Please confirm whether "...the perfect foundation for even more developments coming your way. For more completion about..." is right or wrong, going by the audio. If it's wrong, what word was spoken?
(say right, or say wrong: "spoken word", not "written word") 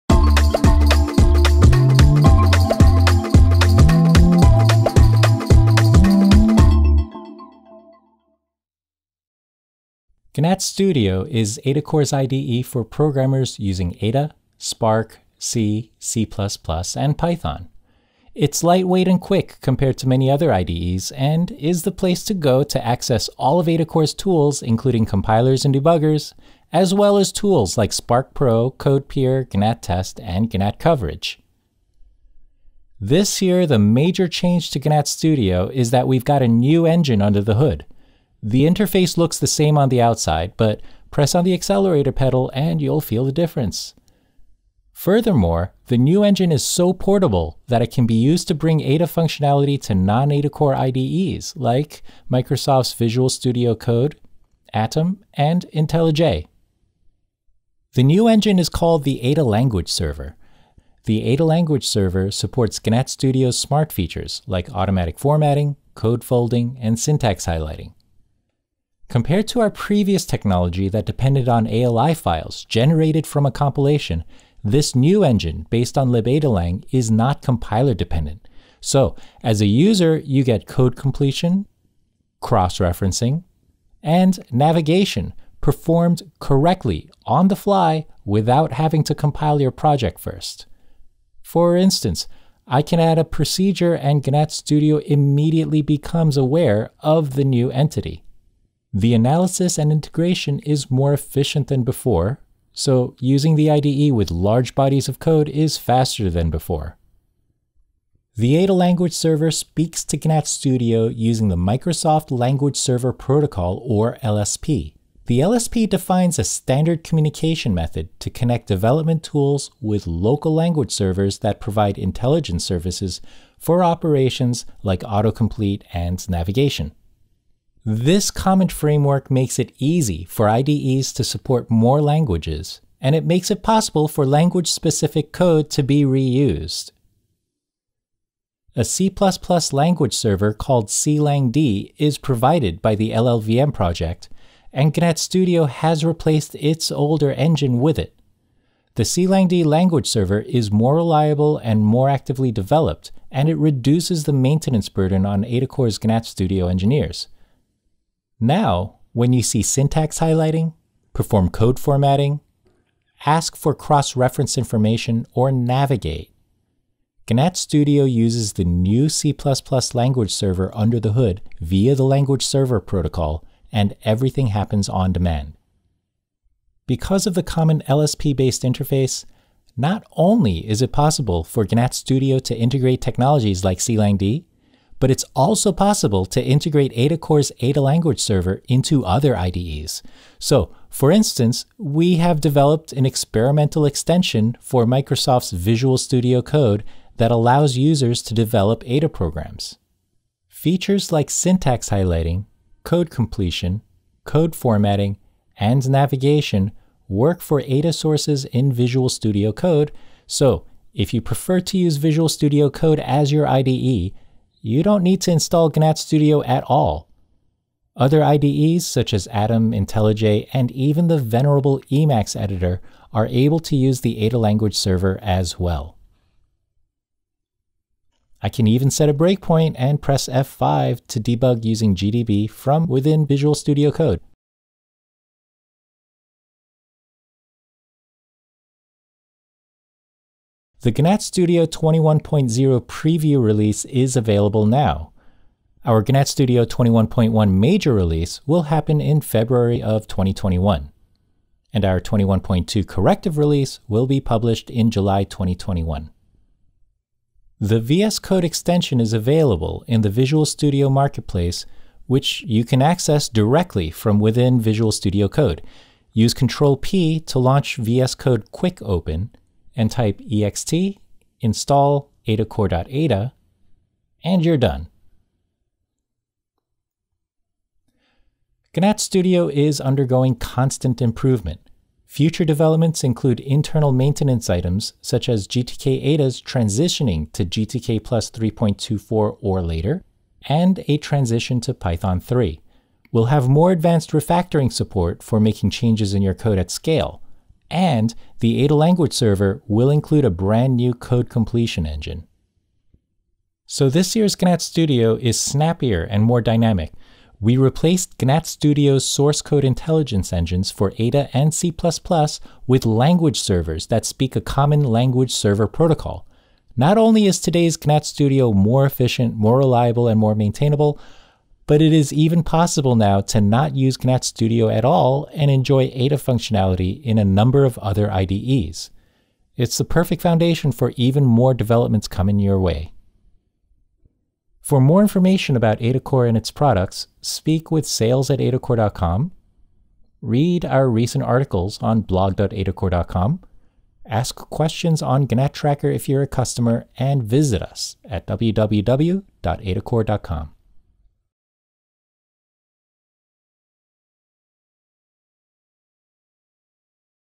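wrong: "information", not "completion".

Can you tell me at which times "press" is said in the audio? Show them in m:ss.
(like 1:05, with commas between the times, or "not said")
0:41, 3:50.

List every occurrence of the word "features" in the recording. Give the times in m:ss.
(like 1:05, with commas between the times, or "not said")
1:03, 3:20.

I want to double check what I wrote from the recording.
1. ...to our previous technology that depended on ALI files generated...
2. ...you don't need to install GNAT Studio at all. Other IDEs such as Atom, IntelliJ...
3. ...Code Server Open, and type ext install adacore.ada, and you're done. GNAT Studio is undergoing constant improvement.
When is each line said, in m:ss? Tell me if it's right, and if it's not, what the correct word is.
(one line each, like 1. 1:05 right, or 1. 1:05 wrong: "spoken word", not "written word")
1. 1:09 right
2. 3:34 right
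3. 4:28 wrong: "Quick", not "Server".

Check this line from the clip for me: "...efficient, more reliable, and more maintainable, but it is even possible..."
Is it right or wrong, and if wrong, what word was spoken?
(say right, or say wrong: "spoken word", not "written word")
right.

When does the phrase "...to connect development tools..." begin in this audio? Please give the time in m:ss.
1:58.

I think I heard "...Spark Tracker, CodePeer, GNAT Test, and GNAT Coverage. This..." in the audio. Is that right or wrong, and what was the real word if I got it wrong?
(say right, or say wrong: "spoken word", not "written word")
wrong: "Pro", not "Tracker".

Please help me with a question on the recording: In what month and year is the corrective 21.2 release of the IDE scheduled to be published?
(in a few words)
July 2021.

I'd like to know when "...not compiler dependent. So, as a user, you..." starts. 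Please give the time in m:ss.
1:17.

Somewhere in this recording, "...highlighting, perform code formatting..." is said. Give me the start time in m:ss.
2:40.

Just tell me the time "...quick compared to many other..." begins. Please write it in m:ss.
0:19.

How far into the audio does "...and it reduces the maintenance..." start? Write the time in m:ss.
2:33.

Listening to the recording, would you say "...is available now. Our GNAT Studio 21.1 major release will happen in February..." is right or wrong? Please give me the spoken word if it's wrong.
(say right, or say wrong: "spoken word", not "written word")
right.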